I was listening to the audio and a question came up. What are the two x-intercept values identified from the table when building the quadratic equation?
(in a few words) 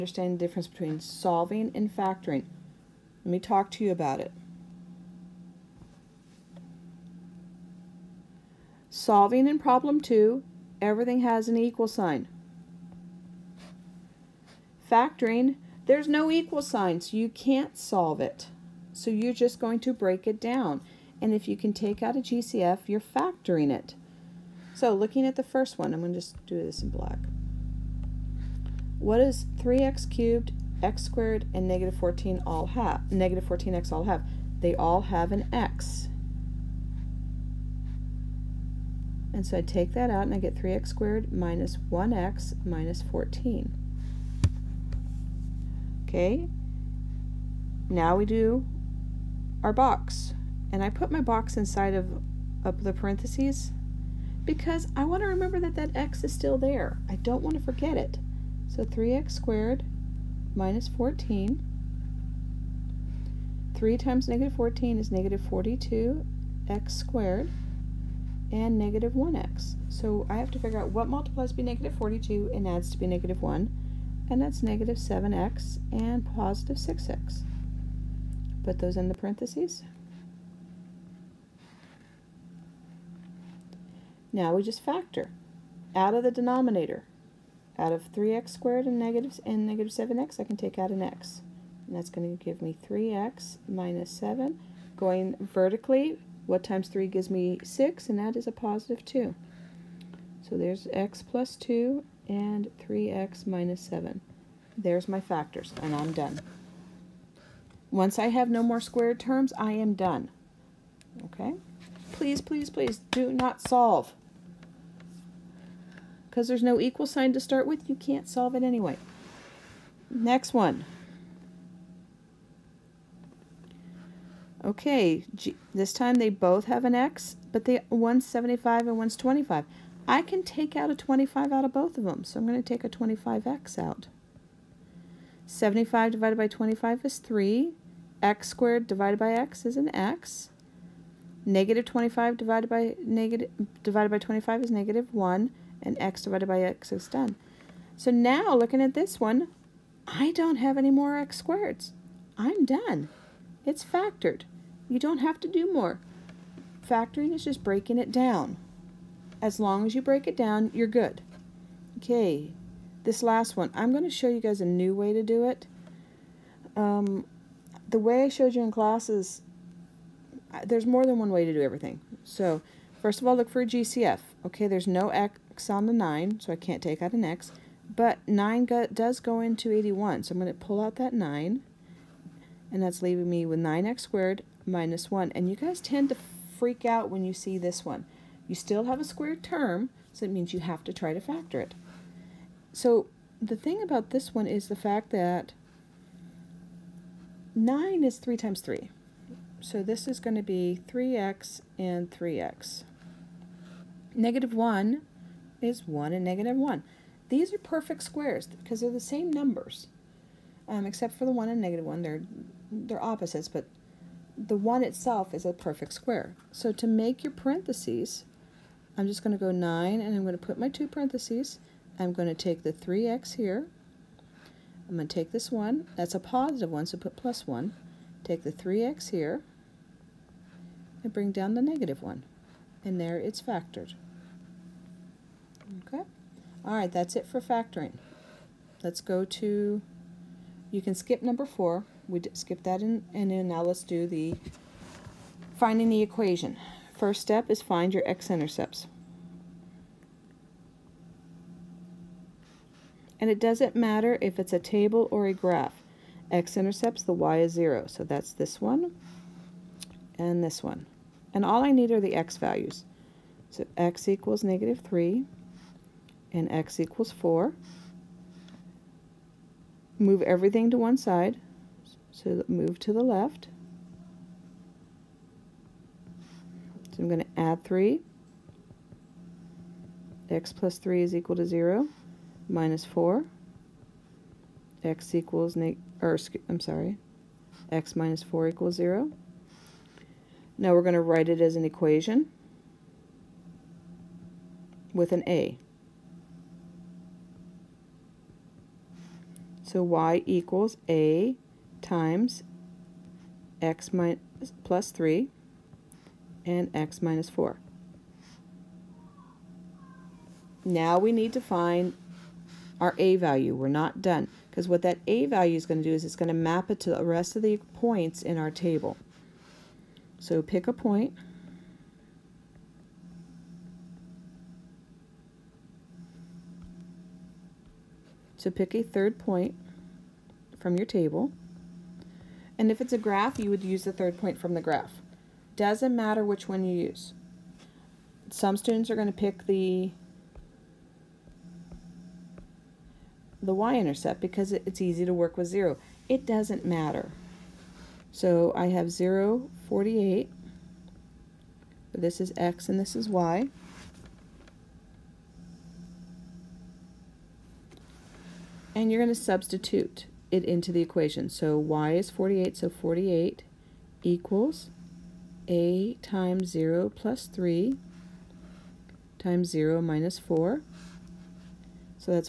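-3 and 4.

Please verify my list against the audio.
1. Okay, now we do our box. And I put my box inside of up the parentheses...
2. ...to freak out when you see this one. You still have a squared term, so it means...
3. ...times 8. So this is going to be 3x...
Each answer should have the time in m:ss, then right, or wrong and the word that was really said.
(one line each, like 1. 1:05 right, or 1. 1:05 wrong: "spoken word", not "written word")
1. 0:46 right
2. 3:06 right
3. 3:18 wrong: "3", not "8".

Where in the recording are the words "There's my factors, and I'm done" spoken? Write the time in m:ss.
1:44.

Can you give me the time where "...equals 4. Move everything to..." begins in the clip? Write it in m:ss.
4:26.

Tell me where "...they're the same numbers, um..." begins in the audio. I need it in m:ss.
3:28.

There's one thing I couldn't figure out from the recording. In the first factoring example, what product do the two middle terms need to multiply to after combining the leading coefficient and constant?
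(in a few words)
-42.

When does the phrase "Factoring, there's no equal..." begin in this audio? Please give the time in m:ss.
0:14.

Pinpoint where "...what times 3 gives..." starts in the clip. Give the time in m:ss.
1:36.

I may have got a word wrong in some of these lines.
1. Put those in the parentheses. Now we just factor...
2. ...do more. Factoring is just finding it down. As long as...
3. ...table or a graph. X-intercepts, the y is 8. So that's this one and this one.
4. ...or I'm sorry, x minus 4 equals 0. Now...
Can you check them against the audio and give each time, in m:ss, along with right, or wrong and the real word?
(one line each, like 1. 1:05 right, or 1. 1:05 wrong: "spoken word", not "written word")
1. 1:18 right
2. 2:35 wrong: "breaking", not "finding"
3. 4:14 wrong: "0", not "8"
4. 4:46 right.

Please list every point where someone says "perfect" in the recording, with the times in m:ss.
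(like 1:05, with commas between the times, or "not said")
3:27, 3:35.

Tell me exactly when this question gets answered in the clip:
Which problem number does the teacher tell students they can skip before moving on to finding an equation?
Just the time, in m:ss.
4:01.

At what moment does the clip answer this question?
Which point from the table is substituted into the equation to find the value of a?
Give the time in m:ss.
5:48.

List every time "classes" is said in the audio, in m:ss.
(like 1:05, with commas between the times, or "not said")
2:48.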